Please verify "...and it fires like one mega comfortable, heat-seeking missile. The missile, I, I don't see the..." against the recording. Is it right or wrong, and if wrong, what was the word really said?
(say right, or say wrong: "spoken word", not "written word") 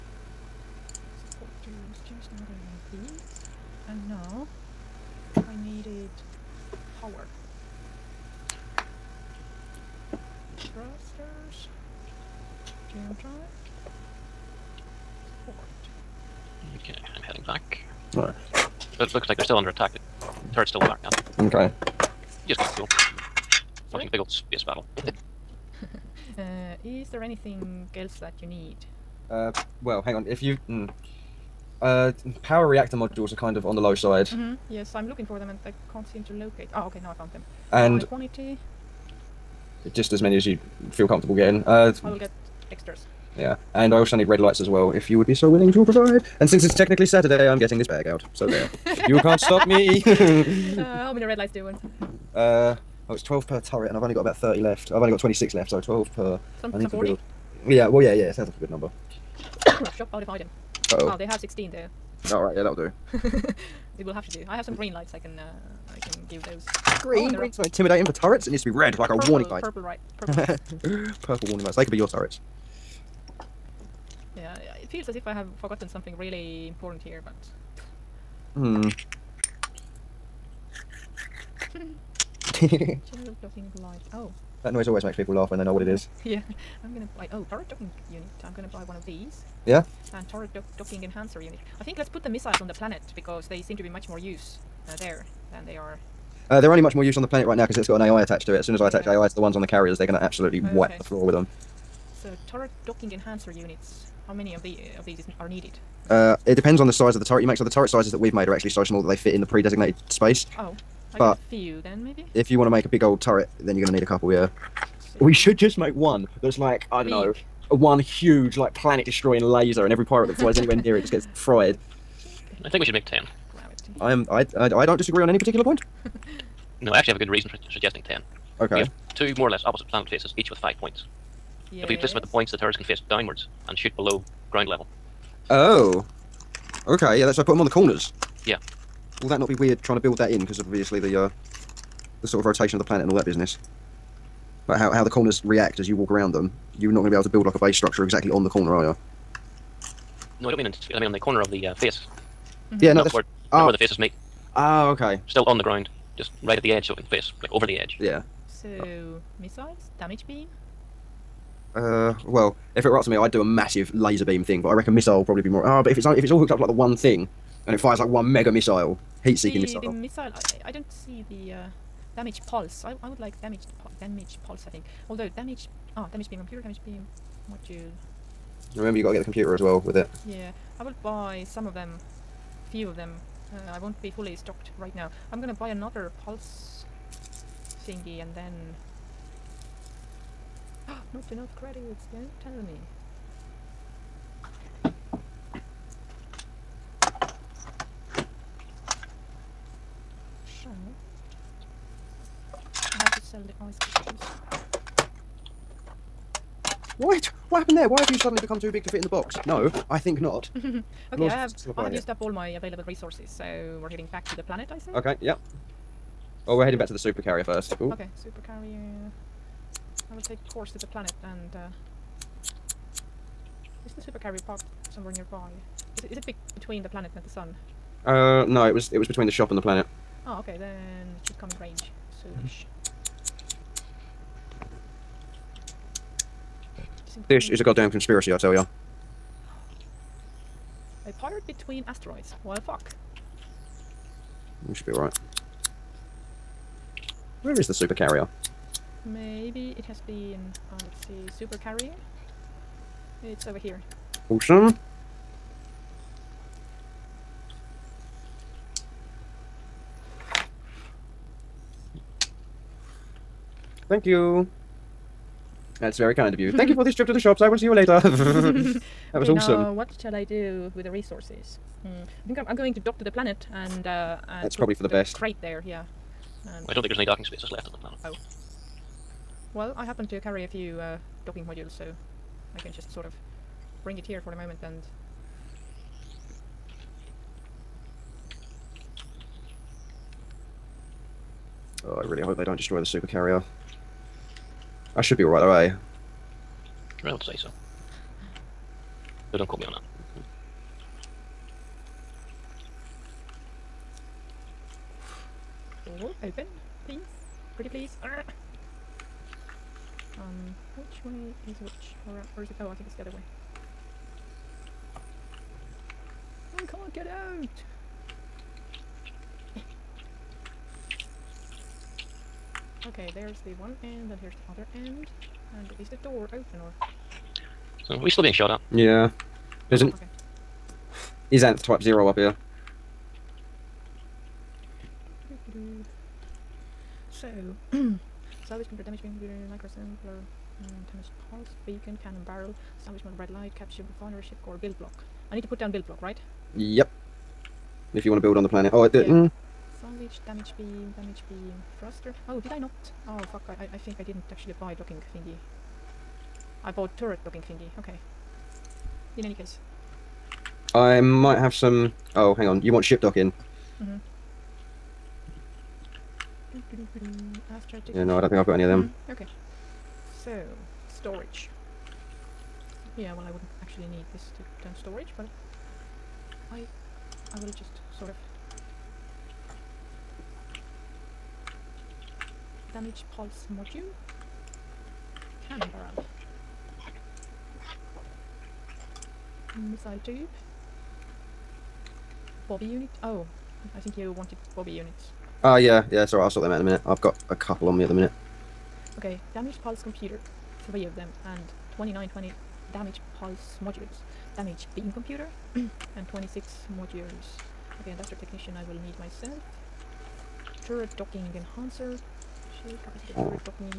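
wrong: "missile", not "comfortable".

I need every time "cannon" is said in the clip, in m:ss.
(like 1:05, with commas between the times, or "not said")
5:42, 6:25.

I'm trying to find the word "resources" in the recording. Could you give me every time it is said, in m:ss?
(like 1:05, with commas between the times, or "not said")
3:32, 4:30.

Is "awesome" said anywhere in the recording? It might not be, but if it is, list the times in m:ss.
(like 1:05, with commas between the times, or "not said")
4:14, 4:29.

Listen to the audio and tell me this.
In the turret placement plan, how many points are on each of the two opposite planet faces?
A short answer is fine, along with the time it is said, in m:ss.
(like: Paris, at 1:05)
5, at 2:10.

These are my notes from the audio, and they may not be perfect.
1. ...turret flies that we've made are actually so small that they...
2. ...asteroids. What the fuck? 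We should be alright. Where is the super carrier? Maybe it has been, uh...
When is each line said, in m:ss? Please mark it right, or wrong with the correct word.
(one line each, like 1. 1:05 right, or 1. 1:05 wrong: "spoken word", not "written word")
1. 1:47 wrong: "sizes", not "flies"
2. 4:01 right.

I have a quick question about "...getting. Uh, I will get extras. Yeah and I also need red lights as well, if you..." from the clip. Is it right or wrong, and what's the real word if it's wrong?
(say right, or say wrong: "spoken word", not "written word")
right.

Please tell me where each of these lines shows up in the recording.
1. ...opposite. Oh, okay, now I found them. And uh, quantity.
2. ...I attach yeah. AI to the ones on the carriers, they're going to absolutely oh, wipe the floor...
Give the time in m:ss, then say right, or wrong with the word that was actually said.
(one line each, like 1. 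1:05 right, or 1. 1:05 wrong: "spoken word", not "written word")
1. 0:36 wrong: "locate", not "opposite"
2. 1:38 right.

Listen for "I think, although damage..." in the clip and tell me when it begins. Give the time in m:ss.
2:54.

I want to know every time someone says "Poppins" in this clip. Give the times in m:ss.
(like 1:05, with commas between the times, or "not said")
not said.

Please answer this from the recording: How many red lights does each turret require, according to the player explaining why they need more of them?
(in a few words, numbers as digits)
12.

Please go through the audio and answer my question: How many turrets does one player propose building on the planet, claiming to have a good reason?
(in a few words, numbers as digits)
10.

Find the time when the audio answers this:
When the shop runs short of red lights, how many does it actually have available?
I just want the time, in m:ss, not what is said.
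1:01.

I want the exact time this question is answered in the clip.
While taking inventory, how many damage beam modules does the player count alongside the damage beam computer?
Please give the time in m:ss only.
6:46.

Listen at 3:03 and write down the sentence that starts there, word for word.
Uh, I won't be fully stocked right now.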